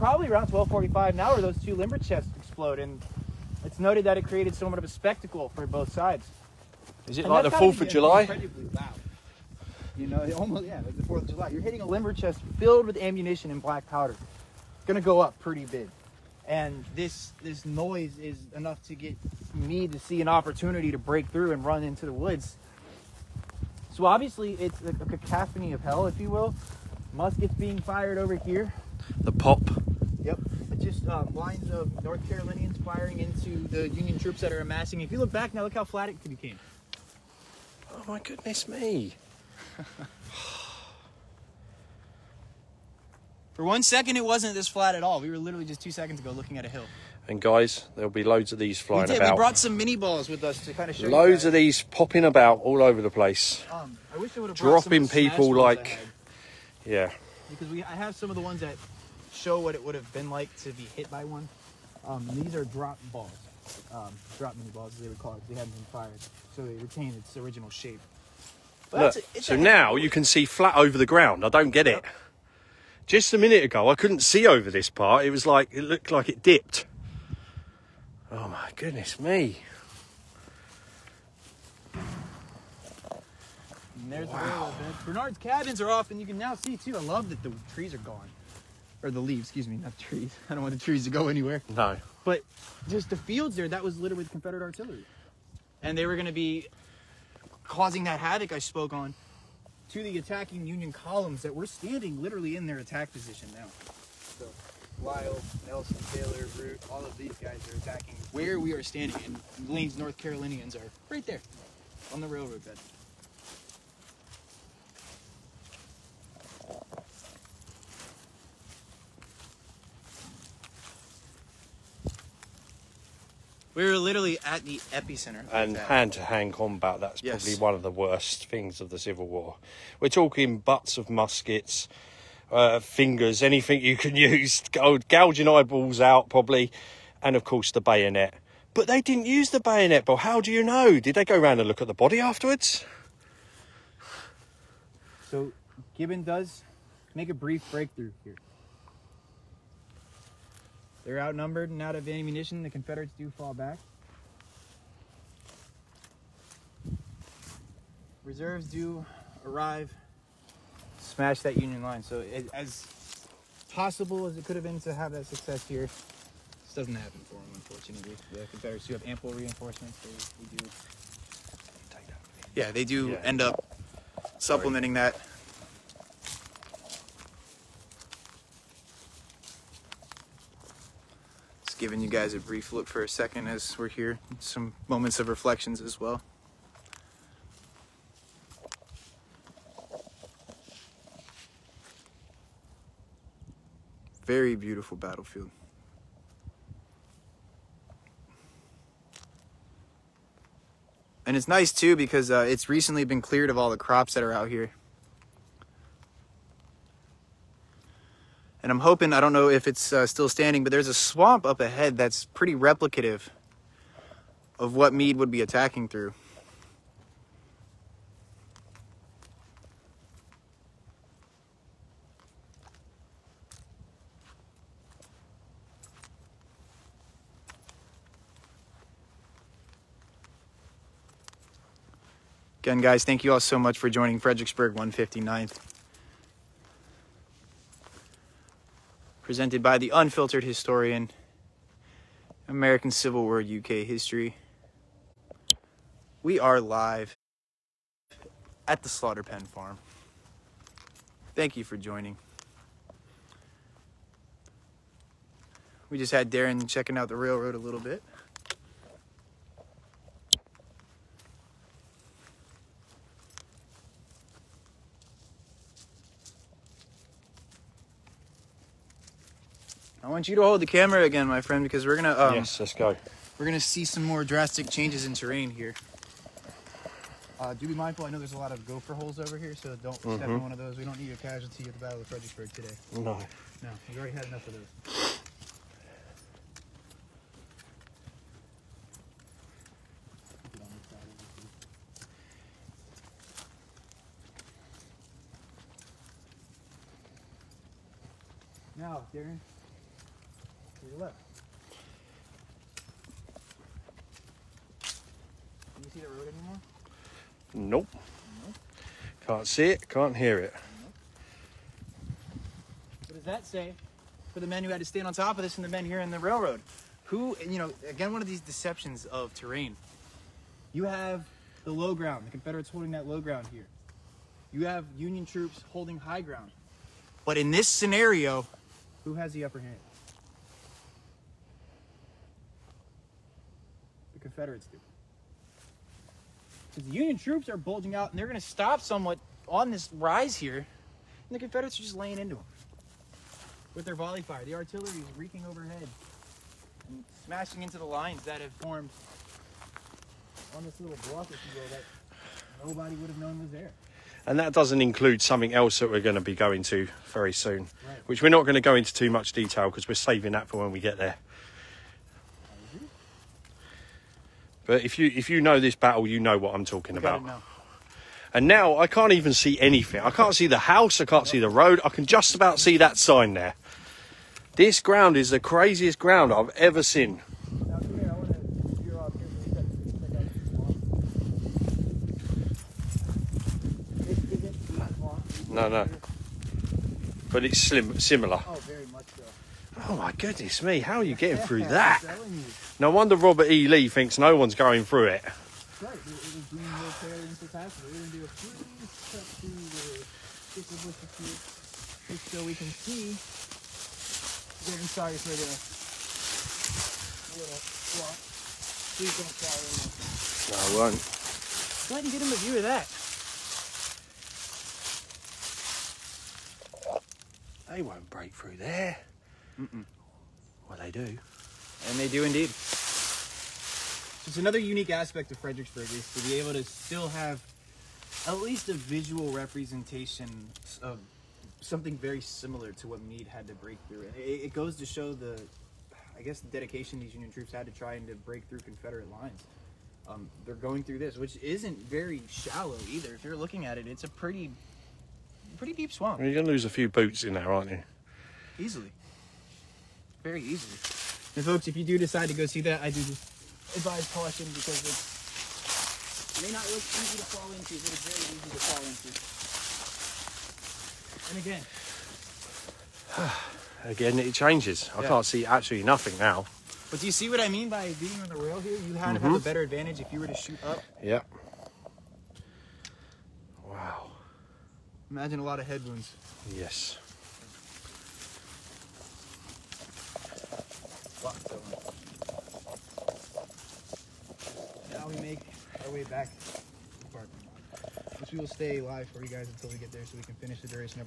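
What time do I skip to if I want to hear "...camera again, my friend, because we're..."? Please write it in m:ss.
4:30.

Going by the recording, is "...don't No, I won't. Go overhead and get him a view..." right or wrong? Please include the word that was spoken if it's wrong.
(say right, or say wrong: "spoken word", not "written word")
wrong: "ahead", not "overhead".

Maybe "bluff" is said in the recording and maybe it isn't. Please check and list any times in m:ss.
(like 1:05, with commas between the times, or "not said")
5:51.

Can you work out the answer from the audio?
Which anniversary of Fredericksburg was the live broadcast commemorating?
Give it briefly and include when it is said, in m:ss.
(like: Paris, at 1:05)
159th, at 3:54.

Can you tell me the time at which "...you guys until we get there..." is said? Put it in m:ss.
8:09.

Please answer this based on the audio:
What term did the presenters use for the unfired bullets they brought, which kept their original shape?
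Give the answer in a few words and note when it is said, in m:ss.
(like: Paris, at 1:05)
drop minié balls, at 1:04.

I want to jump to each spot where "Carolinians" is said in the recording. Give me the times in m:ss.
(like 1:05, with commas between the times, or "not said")
0:32, 1:50.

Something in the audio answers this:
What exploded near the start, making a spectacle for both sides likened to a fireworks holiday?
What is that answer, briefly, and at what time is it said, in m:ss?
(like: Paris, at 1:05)
two limber chests, at 0:01.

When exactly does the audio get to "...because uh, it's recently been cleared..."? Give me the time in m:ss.
3:21.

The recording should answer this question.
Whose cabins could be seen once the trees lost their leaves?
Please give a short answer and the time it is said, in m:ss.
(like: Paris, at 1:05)
Bernard's, at 1:25.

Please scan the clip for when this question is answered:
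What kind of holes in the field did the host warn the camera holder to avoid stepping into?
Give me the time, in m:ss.
4:38.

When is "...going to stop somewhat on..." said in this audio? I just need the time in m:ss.
5:38.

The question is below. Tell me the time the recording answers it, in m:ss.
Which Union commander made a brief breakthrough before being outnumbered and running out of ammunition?
2:25.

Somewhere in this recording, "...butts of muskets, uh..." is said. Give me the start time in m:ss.
2:10.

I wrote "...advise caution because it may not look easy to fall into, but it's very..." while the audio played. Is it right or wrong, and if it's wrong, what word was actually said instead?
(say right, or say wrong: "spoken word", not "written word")
right.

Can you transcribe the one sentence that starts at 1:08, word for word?
Look, so now you can see flat over the ground.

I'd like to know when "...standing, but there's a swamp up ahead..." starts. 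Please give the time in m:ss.
3:30.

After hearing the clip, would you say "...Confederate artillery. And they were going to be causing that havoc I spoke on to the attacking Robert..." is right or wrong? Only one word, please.
wrong.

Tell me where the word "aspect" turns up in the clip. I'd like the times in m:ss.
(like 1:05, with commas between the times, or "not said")
7:04.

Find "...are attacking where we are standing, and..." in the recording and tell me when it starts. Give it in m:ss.
1:47.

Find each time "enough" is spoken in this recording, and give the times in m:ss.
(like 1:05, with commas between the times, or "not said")
0:18, 4:44.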